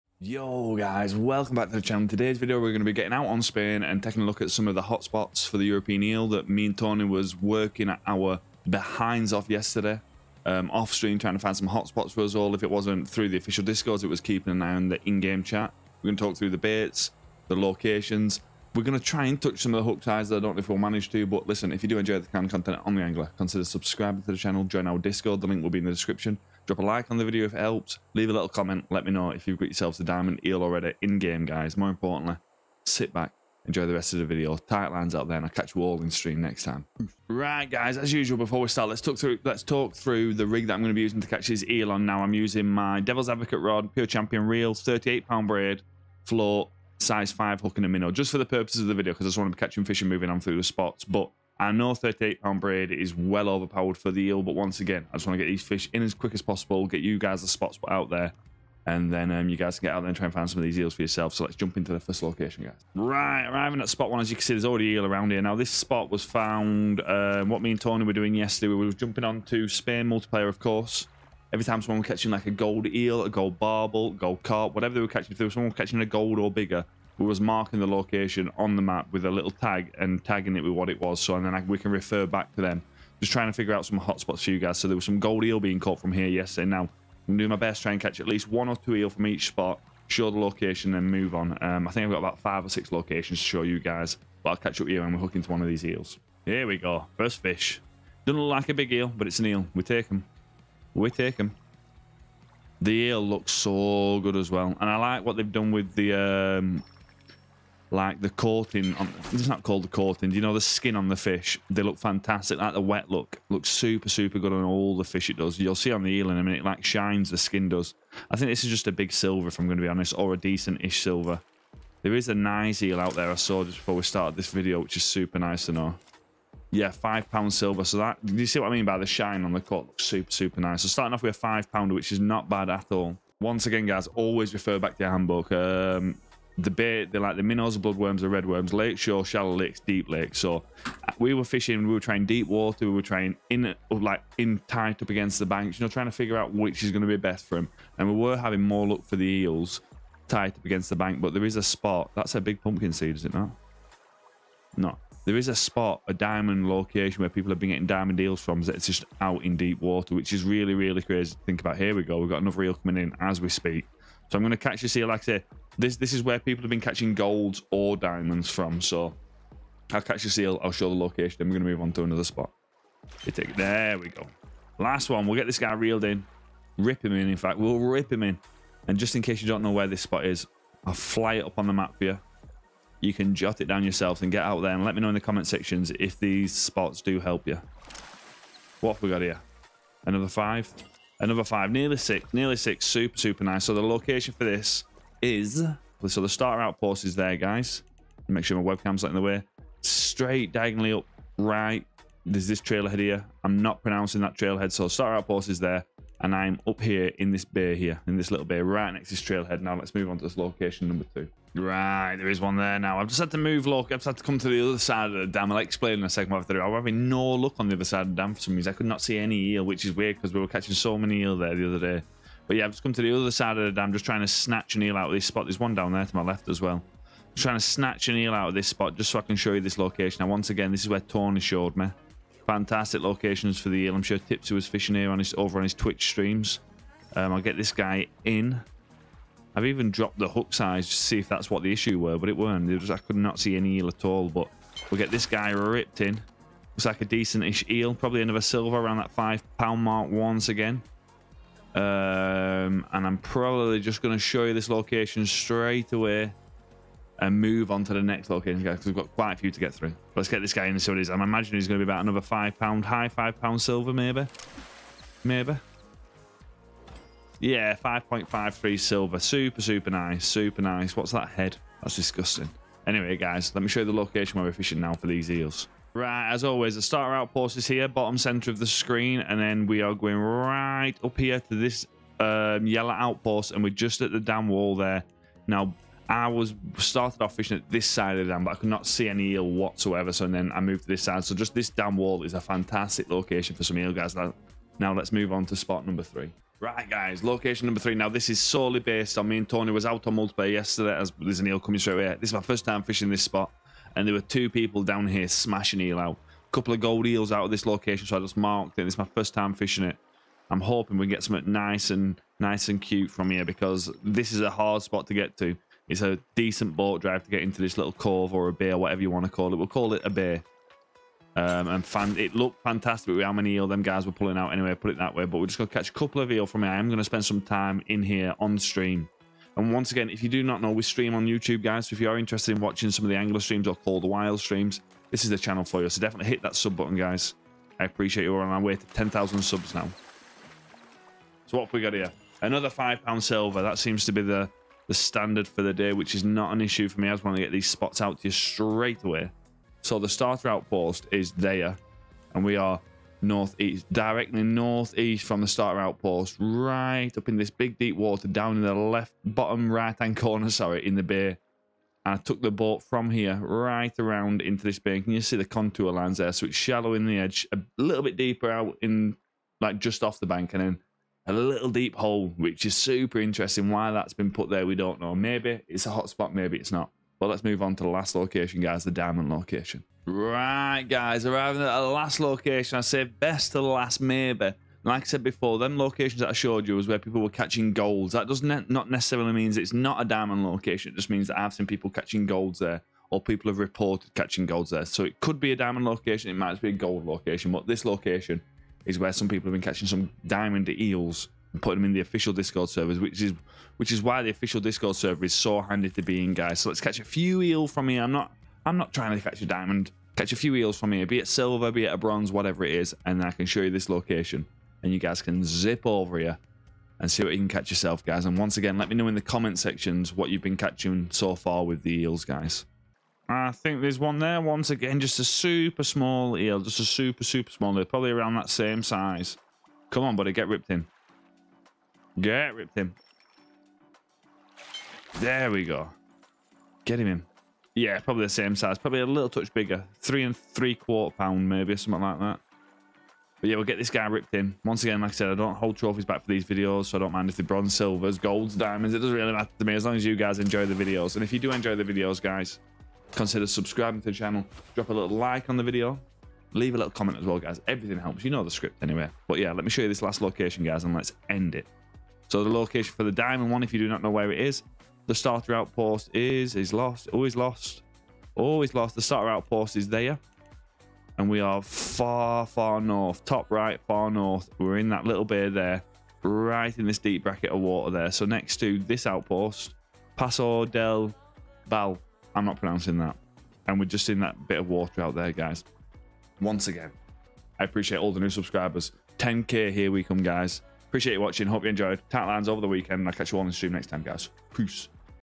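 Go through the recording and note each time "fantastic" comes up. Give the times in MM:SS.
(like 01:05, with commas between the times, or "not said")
01:51, 03:52, 04:52, 05:22.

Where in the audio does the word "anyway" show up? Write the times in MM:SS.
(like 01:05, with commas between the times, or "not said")
04:32, 05:24, 07:38.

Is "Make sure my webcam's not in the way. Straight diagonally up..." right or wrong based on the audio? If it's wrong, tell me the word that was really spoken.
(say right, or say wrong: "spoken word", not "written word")
right.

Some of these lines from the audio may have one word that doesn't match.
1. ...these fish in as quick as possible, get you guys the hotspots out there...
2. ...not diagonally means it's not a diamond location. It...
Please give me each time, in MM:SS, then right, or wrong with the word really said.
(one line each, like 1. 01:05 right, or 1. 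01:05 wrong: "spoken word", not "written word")
1. 00:55 wrong: "spots", not "hotspots"
2. 06:28 wrong: "necessarily", not "diagonally".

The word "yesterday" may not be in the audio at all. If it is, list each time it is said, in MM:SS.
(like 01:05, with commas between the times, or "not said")
00:09, 01:08, 01:26, 05:00.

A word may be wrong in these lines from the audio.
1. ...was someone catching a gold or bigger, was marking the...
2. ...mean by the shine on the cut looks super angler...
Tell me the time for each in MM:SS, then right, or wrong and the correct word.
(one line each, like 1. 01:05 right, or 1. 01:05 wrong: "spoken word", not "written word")
1. 01:15 right
2. 02:08 wrong: "super", not "angler".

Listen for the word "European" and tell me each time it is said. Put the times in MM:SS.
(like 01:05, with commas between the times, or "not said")
00:05.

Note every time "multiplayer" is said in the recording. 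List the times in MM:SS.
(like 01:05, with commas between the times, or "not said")
01:10, 05:00.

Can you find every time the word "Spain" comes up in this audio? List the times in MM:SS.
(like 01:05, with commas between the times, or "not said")
00:03, 01:09.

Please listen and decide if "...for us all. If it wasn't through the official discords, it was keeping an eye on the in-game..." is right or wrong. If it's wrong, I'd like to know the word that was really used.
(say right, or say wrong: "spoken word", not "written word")
right.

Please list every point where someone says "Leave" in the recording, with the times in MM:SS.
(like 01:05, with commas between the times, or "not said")
00:28, 07:36.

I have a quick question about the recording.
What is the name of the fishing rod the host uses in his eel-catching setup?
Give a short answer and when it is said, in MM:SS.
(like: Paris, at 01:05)
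Devil's Advocate, at 00:43.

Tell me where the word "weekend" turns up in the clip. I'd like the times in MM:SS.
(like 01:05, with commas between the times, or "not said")
08:12.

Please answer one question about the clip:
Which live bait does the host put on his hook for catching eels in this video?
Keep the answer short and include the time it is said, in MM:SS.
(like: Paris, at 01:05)
minnow, at 00:47.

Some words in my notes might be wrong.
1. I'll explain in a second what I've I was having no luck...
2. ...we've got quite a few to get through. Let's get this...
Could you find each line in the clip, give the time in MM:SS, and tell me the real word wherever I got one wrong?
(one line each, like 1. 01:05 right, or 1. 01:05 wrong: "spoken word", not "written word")
1. 03:35 right
2. 04:18 right.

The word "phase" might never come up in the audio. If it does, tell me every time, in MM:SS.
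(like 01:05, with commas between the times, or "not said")
not said.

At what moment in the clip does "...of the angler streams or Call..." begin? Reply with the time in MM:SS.
05:33.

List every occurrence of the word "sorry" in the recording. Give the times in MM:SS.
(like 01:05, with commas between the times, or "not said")
06:00.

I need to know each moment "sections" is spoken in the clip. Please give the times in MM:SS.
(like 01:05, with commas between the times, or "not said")
03:05, 06:59.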